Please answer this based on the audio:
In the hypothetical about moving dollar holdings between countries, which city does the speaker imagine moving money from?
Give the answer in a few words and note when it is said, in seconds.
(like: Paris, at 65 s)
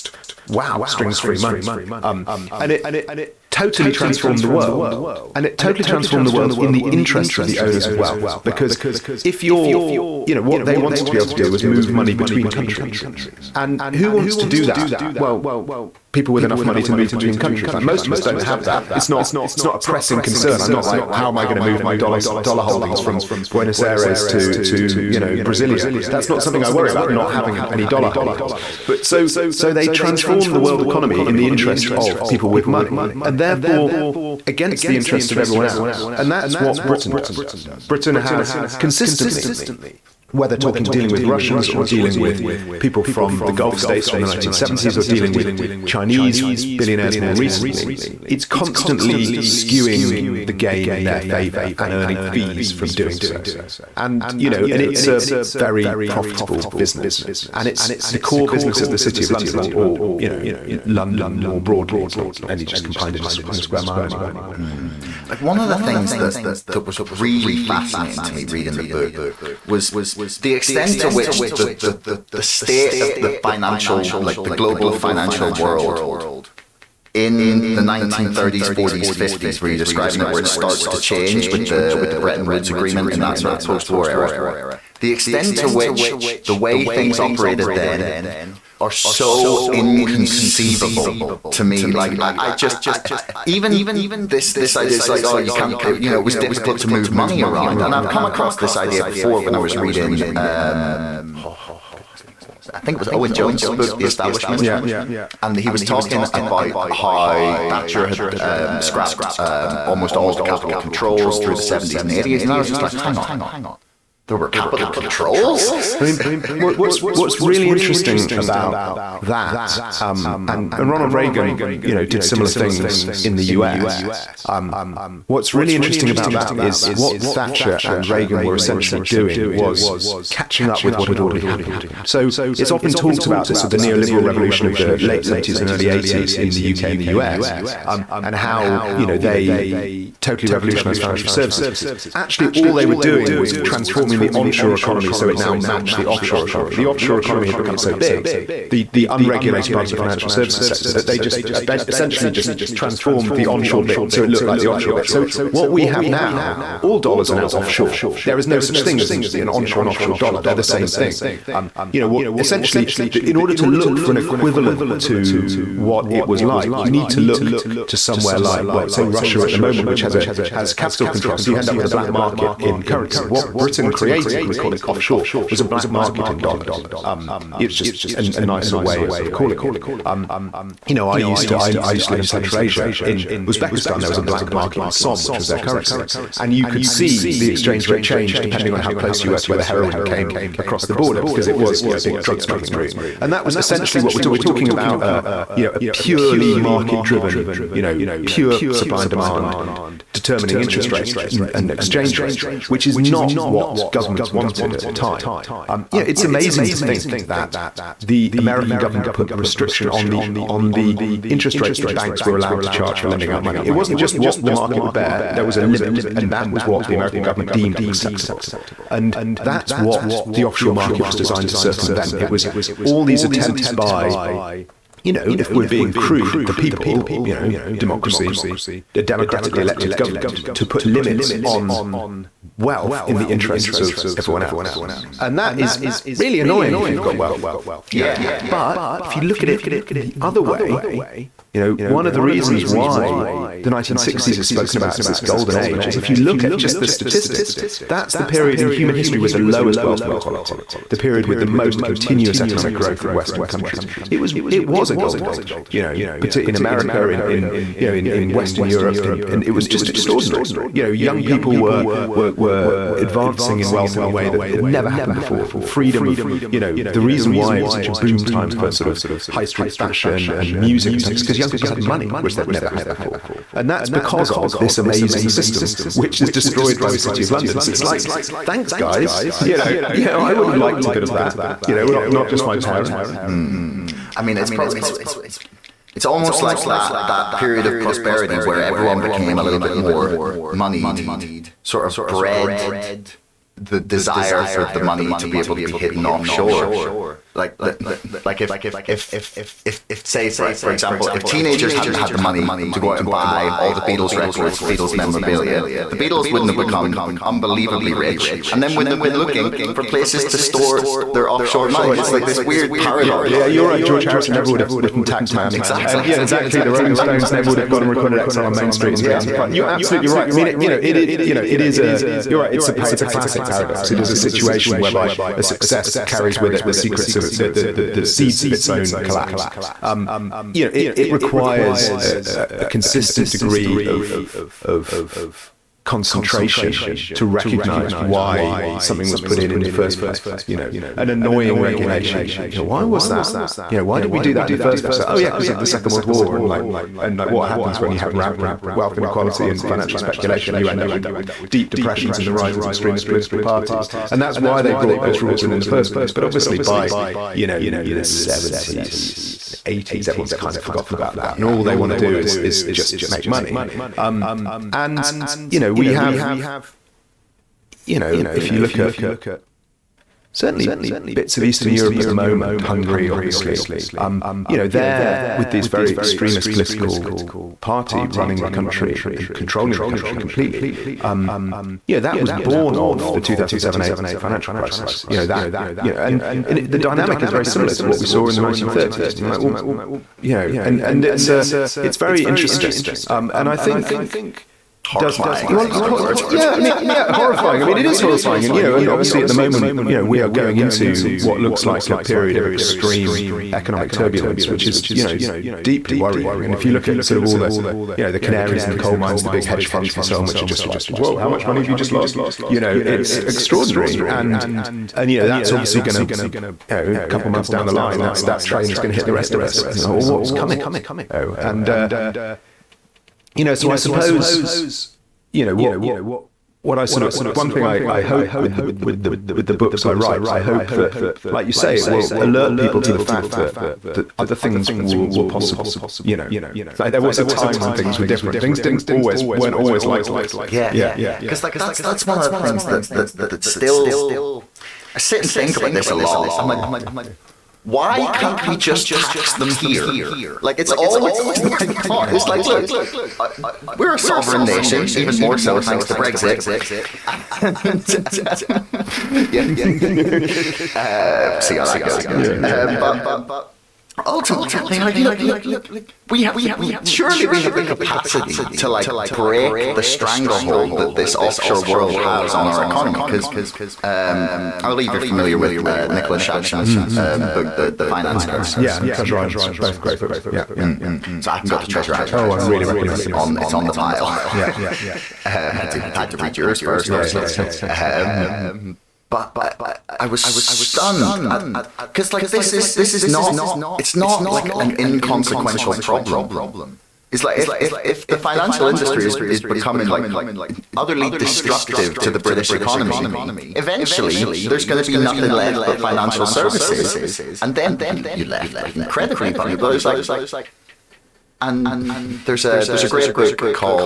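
Buenos Aires, at 23 s.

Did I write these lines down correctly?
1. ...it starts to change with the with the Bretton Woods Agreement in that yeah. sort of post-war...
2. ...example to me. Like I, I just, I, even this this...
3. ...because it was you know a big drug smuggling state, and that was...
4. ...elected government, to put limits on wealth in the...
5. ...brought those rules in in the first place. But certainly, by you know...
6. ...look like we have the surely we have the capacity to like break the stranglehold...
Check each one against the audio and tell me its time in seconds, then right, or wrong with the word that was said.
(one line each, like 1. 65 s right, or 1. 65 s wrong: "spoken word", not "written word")
1. 80 s right
2. 89 s wrong: "inconceivable", not "example"
3. 191 s wrong: "route", not "state"
4. 229 s right
5. 354 s wrong: "obviously", not "certainly"
6. 464 s right.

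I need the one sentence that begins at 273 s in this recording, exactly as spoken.
And that's because of this amazing system, which is destroyed by the City of London.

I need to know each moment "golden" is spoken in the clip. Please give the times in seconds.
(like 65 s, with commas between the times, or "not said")
245 s, 254 s.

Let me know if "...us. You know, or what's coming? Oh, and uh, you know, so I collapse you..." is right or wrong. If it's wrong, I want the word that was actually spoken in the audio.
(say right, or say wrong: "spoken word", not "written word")
wrong: "suppose", not "collapse".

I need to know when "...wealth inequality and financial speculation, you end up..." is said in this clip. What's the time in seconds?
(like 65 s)
348 s.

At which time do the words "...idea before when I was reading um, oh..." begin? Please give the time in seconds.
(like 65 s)
98 s.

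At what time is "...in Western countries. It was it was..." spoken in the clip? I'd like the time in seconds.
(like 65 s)
253 s.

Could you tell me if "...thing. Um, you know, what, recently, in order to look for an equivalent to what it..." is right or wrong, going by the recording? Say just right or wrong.
wrong.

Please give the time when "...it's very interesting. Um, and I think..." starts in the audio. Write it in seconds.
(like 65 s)
391 s.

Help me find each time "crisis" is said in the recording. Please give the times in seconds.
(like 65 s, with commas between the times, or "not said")
384 s.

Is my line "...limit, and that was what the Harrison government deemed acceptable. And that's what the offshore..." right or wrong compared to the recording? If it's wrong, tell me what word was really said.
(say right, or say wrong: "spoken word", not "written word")
wrong: "American", not "Harrison".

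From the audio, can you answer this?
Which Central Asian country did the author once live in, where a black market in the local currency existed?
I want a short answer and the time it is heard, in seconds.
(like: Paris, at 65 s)
Uzbekistan, at 183 s.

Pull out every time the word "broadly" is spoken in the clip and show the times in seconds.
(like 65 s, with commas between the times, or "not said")
61 s.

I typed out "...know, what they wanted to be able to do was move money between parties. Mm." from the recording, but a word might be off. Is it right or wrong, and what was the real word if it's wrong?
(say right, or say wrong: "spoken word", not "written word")
wrong: "countries", not "parties".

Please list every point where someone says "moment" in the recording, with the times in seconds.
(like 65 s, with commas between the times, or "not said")
169 s, 372 s, 399 s.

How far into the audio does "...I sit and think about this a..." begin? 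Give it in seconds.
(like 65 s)
444 s.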